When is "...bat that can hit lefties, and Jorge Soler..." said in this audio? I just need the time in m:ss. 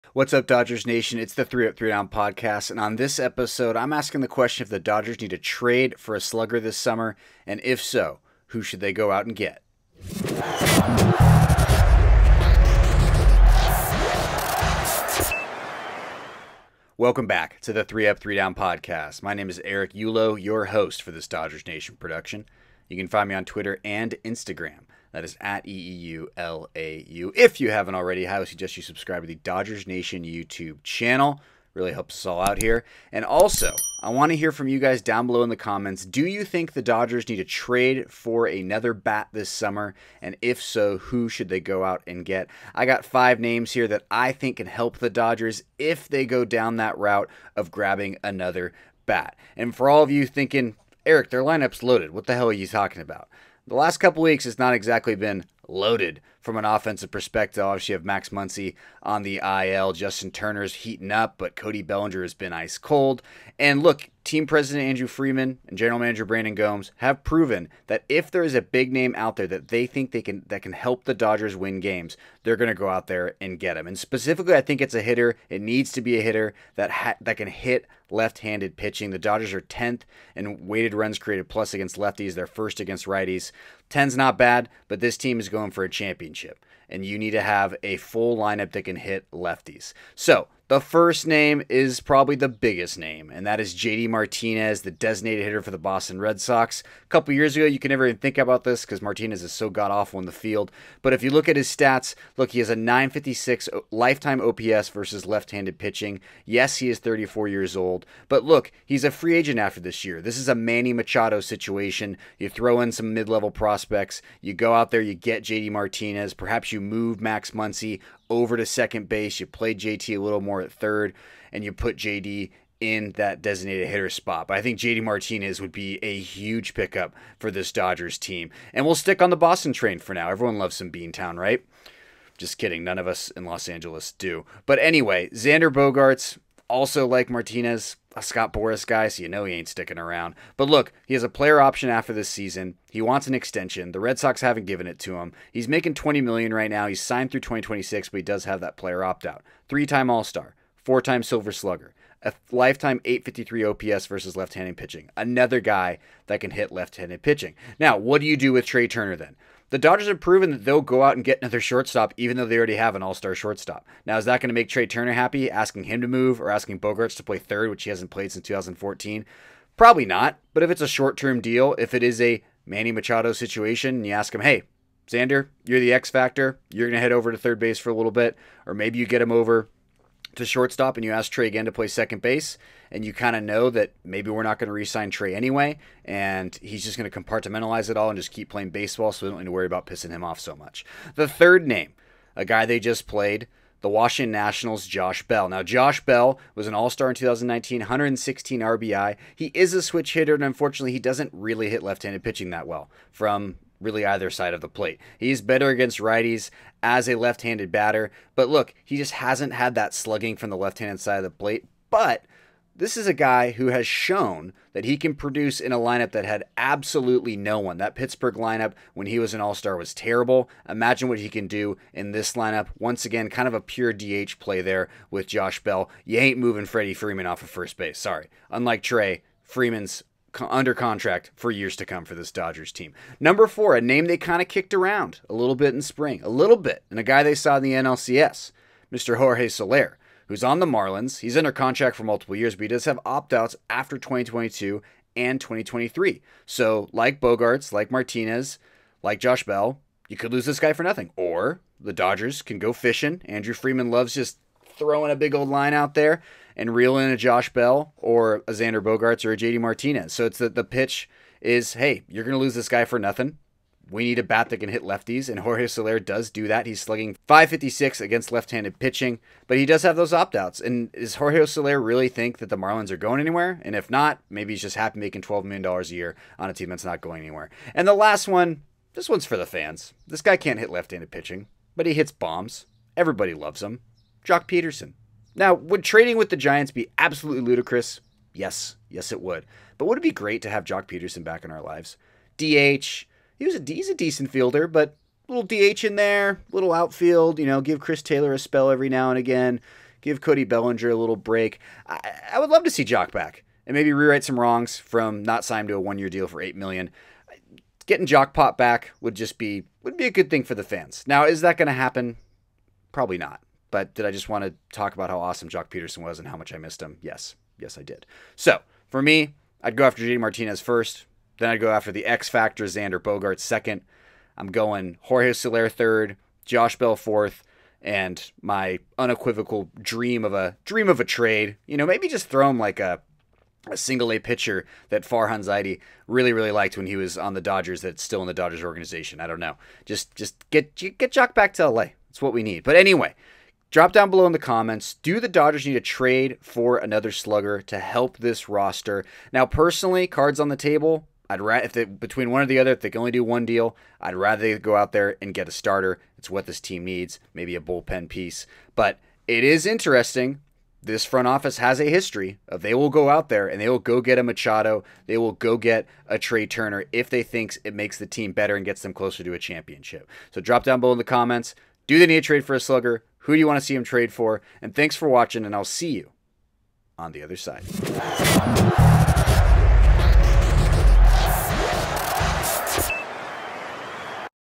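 4:24.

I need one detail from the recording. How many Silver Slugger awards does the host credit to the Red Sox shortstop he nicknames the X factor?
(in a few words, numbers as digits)
4.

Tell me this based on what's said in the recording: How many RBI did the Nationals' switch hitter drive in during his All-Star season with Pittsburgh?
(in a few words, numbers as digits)
116.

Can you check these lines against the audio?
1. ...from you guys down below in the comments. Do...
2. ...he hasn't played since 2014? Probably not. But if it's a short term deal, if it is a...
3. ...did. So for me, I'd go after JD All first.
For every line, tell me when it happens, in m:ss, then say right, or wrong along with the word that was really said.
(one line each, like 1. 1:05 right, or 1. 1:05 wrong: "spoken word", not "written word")
1. 0:34 right
2. 2:47 right
3. 5:17 wrong: "Martinez", not "All".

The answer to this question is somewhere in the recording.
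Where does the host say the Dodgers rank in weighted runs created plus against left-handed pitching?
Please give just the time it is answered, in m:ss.
1:19.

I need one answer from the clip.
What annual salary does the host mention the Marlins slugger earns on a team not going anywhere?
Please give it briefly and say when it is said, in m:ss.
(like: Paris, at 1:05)
$12 million, at 4:35.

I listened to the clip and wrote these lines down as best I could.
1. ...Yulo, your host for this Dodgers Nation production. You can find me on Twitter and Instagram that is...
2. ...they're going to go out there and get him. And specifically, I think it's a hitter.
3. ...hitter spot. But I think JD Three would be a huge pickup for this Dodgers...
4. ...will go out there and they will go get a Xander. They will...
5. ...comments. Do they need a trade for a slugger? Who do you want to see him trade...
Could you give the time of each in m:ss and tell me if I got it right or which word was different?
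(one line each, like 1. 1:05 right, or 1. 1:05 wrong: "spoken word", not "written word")
1. 0:19 right
2. 1:12 right
3. 2:03 wrong: "Martinez", not "Three"
4. 6:02 wrong: "Machado", not "Xander"
5. 6:11 right.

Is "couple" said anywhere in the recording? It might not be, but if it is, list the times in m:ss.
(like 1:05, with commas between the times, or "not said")
0:53, 1:37.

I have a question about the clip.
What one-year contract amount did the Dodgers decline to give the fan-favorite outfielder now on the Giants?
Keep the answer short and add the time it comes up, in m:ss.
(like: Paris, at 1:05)
8 million, at 5:06.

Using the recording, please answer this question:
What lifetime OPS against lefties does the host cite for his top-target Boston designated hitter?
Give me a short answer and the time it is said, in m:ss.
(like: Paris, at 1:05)
956, at 1:42.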